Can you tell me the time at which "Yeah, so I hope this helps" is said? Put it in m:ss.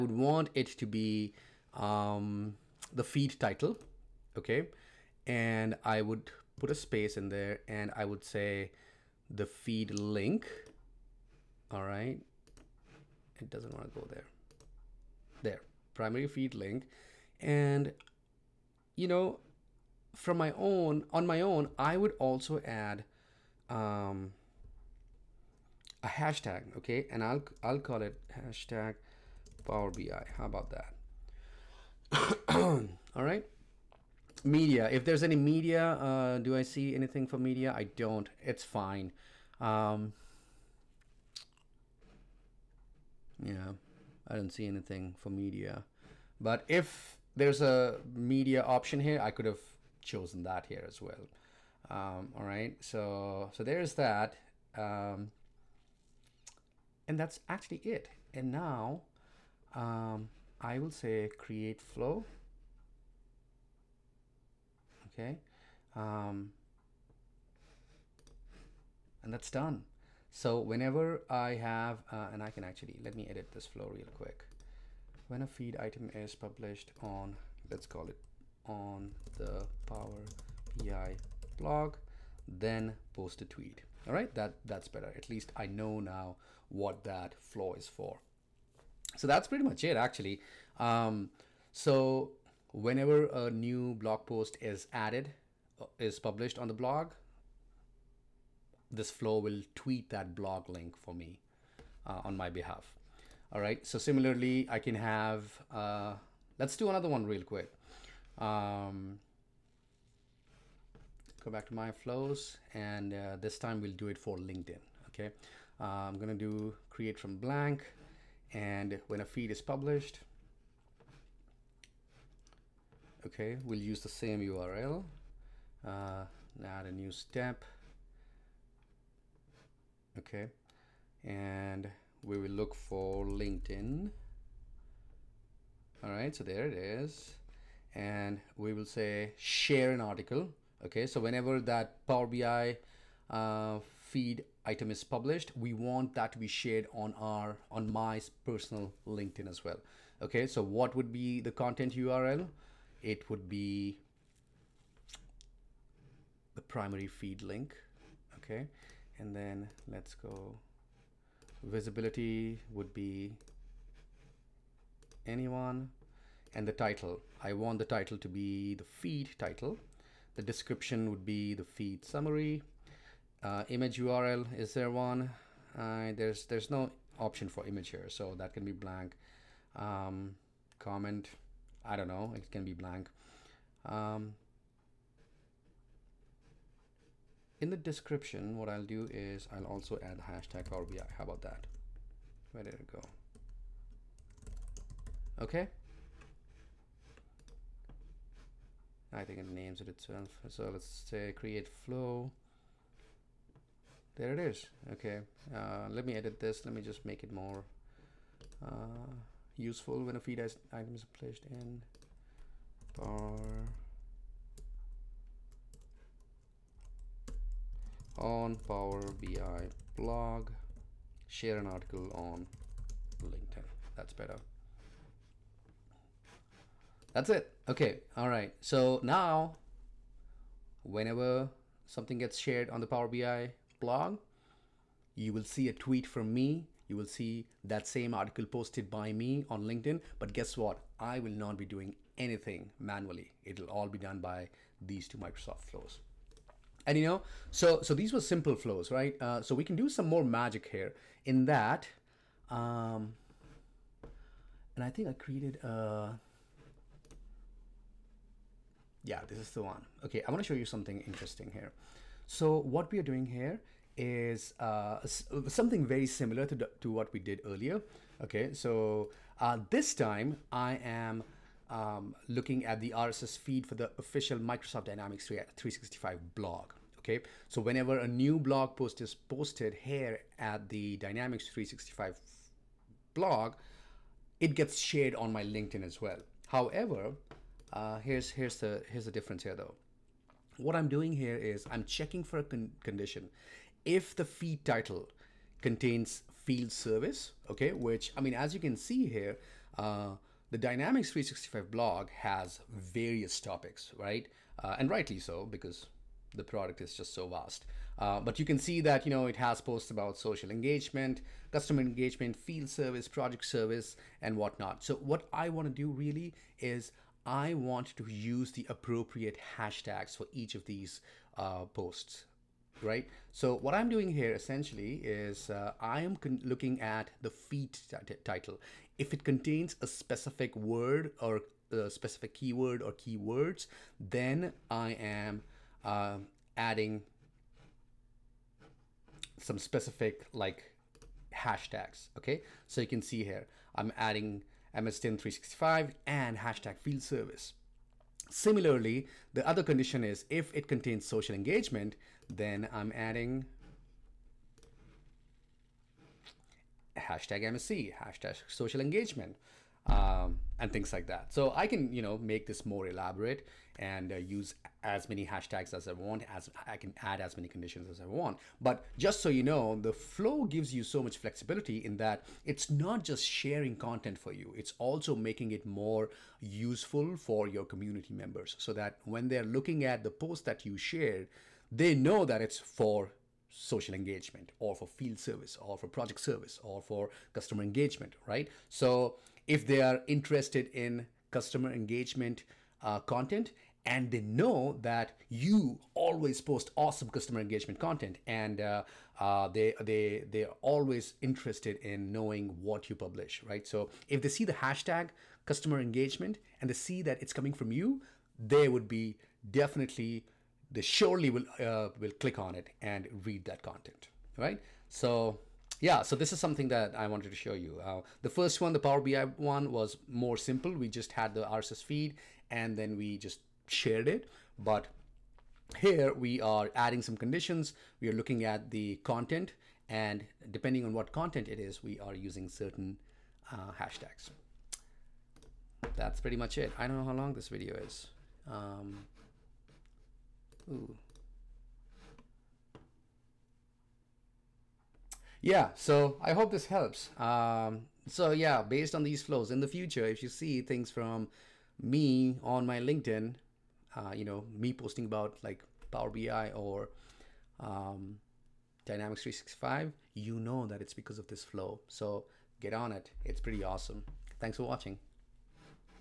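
7:25.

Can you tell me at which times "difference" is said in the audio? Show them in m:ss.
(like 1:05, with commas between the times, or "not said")
4:49.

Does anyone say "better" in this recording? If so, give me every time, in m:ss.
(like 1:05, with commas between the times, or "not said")
1:24, 3:44.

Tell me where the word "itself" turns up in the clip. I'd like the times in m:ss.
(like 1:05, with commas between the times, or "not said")
3:19.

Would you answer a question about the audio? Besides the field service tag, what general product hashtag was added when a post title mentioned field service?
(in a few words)
#MSDyn365.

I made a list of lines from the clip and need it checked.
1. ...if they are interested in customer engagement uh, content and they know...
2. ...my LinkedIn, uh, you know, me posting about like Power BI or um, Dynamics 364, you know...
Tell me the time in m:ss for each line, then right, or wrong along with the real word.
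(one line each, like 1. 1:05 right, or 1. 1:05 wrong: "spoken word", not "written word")
1. 6:29 right
2. 7:32 wrong: "365", not "364".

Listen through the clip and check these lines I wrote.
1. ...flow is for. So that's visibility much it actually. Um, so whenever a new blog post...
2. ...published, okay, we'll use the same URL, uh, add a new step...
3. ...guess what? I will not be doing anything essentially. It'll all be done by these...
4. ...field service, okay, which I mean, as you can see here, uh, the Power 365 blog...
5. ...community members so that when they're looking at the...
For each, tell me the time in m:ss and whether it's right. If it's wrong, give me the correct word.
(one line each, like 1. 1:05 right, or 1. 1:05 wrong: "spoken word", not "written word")
1. 1:27 wrong: "pretty", not "visibility"
2. 1:59 right
3. 4:00 wrong: "manually", not "essentially"
4. 4:56 wrong: "Dynamics", not "Power"
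5. 6:17 right.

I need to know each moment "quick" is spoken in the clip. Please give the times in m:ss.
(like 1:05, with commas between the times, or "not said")
1:14, 1:47.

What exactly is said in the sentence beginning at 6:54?
So yeah, so this is something that I wanted to show you.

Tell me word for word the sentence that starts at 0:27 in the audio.
And I'll, I'll call it hashtag Power BI.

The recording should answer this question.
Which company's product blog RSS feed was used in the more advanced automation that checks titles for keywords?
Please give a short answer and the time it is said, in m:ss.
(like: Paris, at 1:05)
Microsoft Dynamics 365, at 4:34.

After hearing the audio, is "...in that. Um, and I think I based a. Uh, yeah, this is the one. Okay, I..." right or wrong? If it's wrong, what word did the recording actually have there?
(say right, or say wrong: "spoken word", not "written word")
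wrong: "created", not "based".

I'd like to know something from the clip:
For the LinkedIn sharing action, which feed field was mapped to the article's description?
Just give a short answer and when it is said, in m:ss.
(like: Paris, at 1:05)
Feed summary, at 2:51.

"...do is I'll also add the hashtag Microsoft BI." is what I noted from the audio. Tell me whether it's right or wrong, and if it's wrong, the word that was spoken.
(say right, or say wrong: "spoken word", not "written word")
wrong: "Power", not "Microsoft".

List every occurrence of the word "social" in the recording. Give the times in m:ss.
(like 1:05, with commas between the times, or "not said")
5:10, 5:51, 5:58, 6:23.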